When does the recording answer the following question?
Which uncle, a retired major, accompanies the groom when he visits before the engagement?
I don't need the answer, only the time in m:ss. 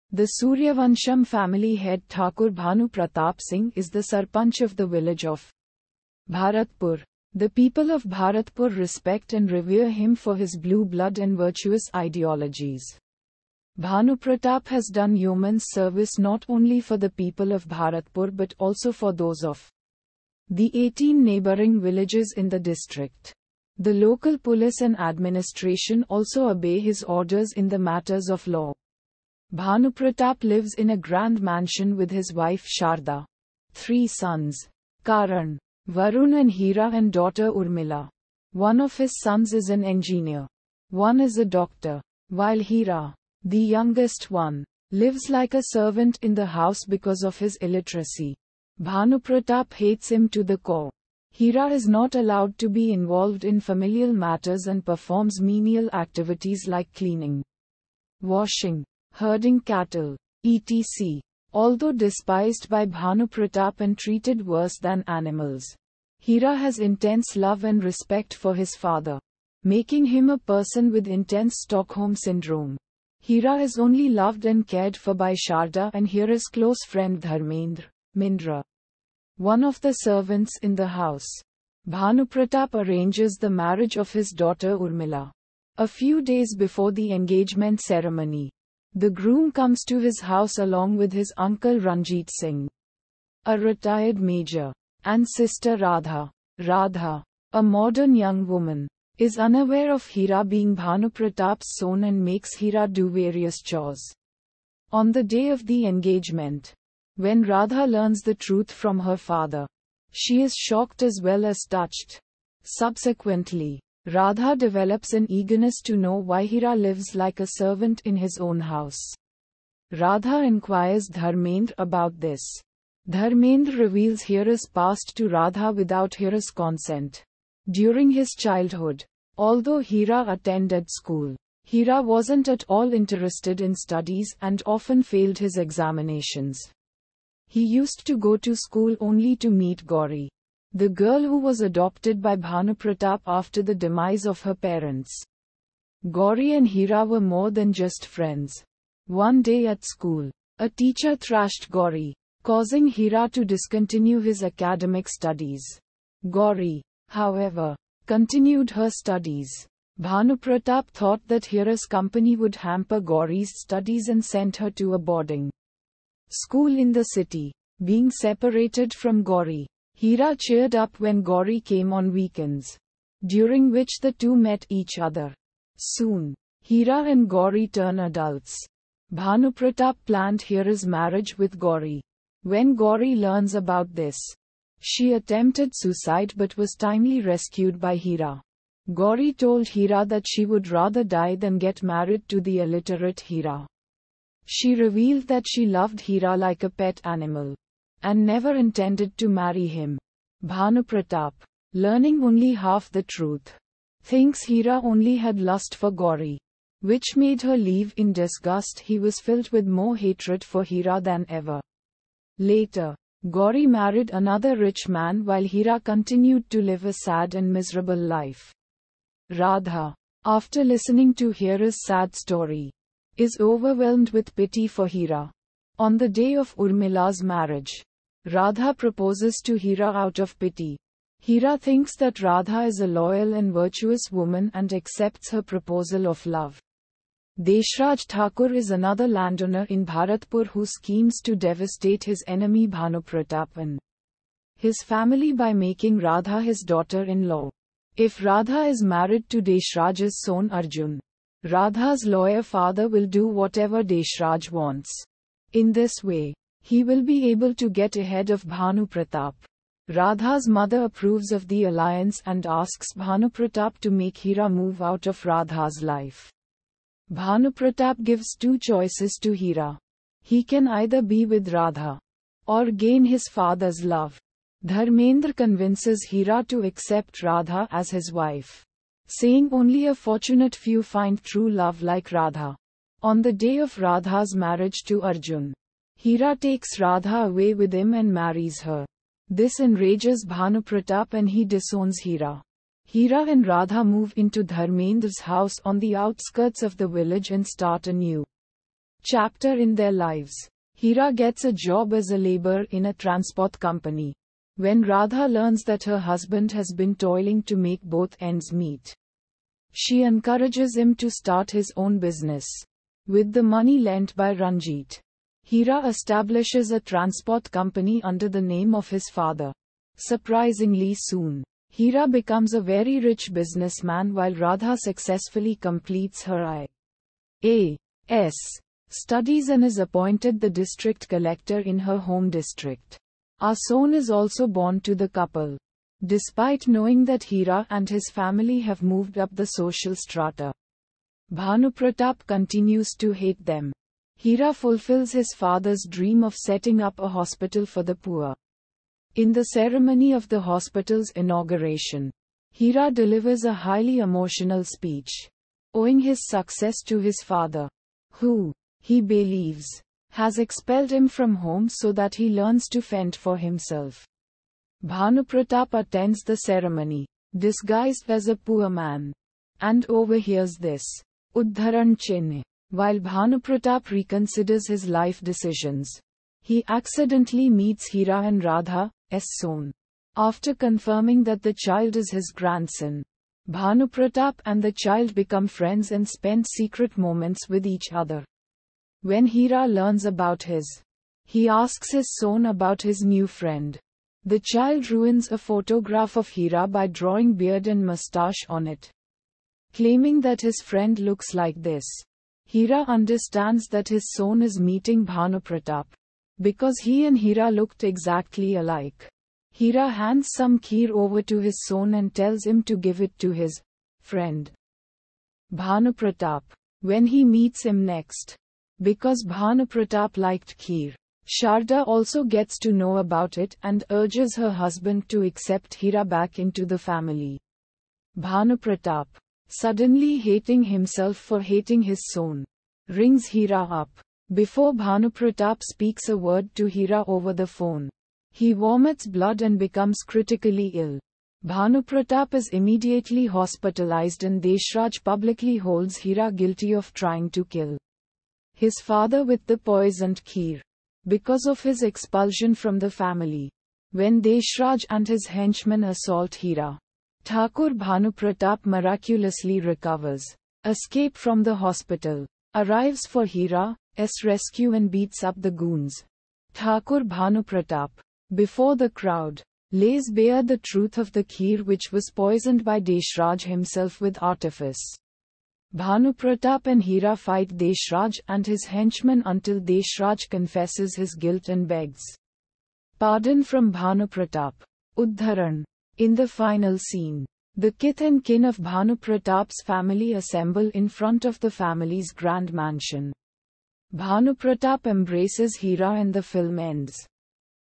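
1:31.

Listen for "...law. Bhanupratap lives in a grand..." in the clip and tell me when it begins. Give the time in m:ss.
0:28.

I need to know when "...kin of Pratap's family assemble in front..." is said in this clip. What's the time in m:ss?
8:08.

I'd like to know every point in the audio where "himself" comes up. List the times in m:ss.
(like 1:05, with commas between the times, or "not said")
6:03, 7:10, 7:53.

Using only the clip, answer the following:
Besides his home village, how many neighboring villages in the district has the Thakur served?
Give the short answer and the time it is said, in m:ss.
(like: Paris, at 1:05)
18, at 0:20.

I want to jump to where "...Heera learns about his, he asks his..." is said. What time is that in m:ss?
6:29.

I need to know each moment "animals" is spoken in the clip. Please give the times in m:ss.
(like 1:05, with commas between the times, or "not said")
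1:05, 3:17.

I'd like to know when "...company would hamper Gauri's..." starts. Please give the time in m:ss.
2:41.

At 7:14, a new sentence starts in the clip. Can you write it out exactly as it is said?
Before Bhanupratap speaks a word to Heera over the phone, he vomits blood and becomes critically ill.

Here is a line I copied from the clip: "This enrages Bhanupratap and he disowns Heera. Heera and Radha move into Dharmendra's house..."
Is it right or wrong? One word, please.
right.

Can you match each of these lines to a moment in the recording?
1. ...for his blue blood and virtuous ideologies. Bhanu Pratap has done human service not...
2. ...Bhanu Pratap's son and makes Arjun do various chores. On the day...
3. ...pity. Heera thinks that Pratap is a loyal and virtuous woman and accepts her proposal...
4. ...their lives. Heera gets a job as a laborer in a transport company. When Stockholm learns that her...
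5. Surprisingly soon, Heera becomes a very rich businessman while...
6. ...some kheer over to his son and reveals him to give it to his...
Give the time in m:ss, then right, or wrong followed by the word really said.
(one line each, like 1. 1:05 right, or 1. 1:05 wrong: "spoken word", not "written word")
1. 0:10 right
2. 1:40 wrong: "Heera", not "Arjun"
3. 3:50 wrong: "Radha", not "Pratap"
4. 4:59 wrong: "Radha", not "Stockholm"
5. 5:19 right
6. 6:50 wrong: "tells", not "reveals".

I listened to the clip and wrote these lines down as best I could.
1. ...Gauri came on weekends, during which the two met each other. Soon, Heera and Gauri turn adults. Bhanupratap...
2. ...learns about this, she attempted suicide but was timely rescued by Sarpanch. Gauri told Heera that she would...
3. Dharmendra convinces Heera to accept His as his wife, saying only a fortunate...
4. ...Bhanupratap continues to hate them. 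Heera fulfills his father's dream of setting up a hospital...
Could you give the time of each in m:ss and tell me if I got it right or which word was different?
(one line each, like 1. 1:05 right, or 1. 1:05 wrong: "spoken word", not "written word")
1. 2:51 right
2. 3:03 wrong: "Heera", not "Sarpanch"
3. 4:34 wrong: "Radha", not "His"
4. 5:41 right.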